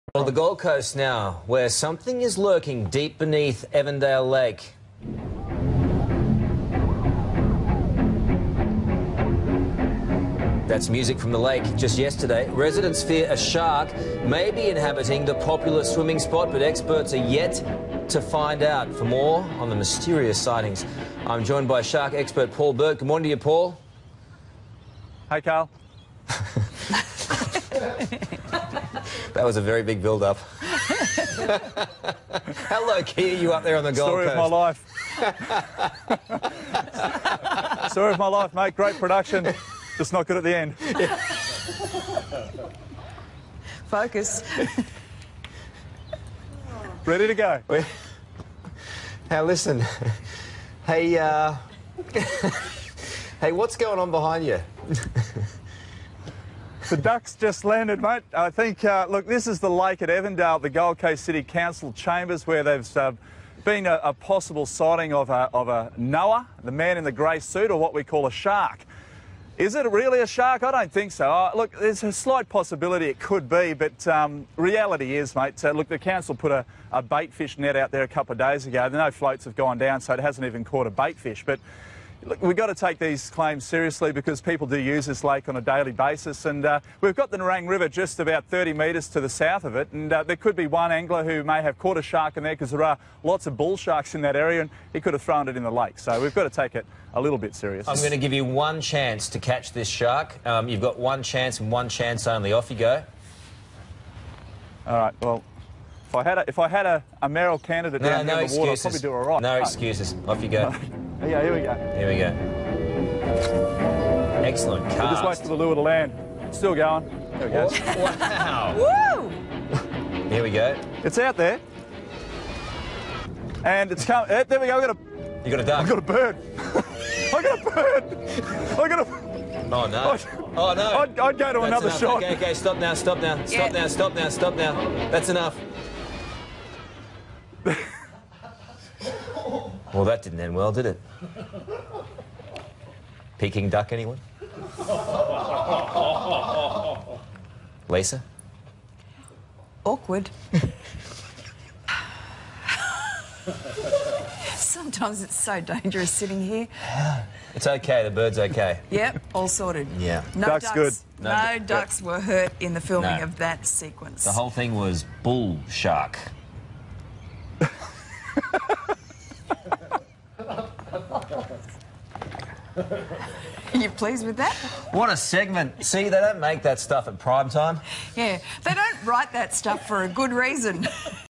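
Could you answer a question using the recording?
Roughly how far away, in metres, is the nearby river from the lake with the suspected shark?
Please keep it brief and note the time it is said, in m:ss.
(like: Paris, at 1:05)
30 metres, at 1:28.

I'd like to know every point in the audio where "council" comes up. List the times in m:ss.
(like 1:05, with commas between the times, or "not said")
1:01, 1:15.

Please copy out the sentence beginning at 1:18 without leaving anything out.
No floats have gone down, so it hasn't even caught a bait fish.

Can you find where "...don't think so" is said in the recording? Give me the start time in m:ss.
1:10.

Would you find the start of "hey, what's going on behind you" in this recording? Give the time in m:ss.
0:53.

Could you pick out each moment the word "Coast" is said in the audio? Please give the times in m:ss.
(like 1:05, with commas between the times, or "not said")
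0:00, 0:34, 1:00.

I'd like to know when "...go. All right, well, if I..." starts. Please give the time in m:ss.
1:42.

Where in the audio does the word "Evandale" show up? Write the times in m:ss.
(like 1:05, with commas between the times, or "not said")
0:03, 1:00.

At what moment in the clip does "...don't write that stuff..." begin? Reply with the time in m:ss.
2:58.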